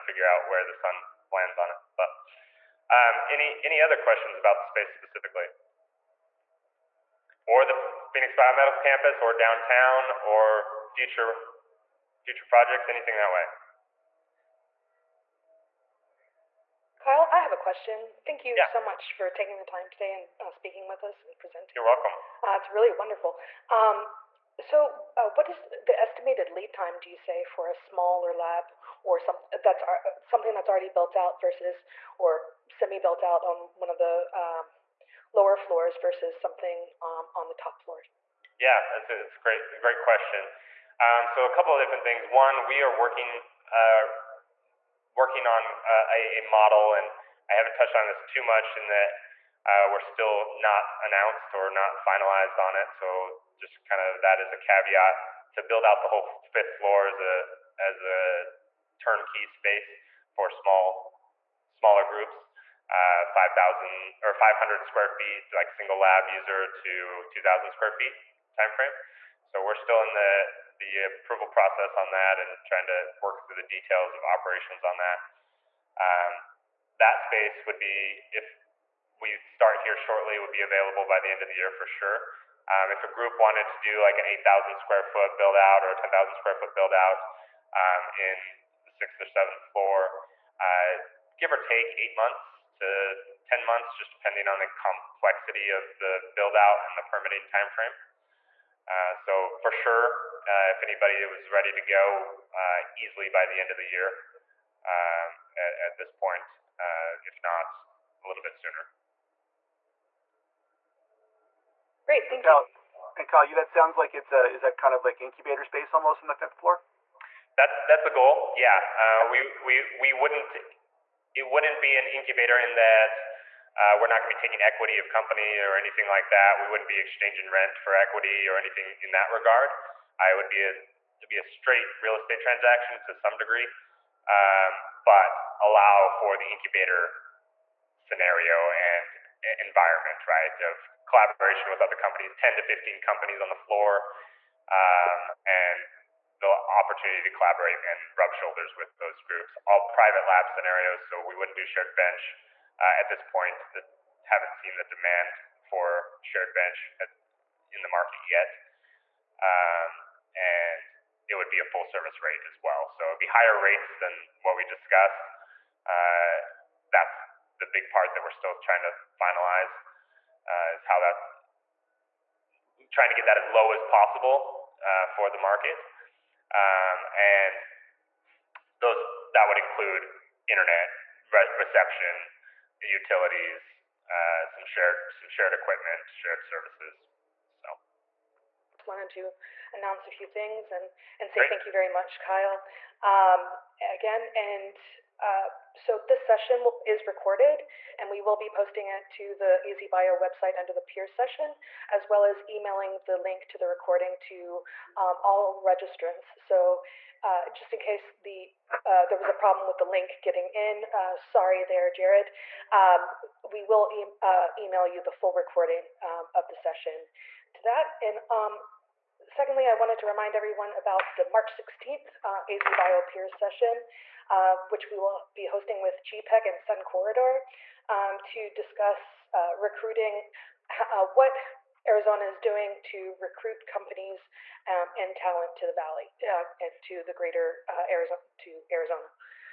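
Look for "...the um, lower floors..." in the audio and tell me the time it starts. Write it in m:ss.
0:33.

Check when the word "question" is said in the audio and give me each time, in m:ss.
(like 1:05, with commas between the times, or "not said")
0:03, 0:17, 0:40.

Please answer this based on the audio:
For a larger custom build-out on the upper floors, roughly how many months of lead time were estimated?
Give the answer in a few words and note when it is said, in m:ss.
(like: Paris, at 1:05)
8 to 10 months, at 1:31.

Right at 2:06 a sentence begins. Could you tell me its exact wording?
We wouldn't be exchanging rent for equity or anything in that regard.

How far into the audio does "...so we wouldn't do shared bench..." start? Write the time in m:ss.
2:31.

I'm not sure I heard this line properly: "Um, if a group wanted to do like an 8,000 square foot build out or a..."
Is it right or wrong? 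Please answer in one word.
right.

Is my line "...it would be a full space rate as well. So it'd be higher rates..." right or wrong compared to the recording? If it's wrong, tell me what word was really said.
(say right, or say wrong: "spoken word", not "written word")
wrong: "service", not "space".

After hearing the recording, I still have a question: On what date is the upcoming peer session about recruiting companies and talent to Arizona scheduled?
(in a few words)
March 16.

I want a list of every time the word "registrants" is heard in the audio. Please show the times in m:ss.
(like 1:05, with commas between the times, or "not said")
3:25.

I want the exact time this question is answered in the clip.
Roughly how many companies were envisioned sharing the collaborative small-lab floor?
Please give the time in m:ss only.
2:22.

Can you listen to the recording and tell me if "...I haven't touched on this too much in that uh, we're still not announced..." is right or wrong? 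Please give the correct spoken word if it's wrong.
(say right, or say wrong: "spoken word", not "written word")
right.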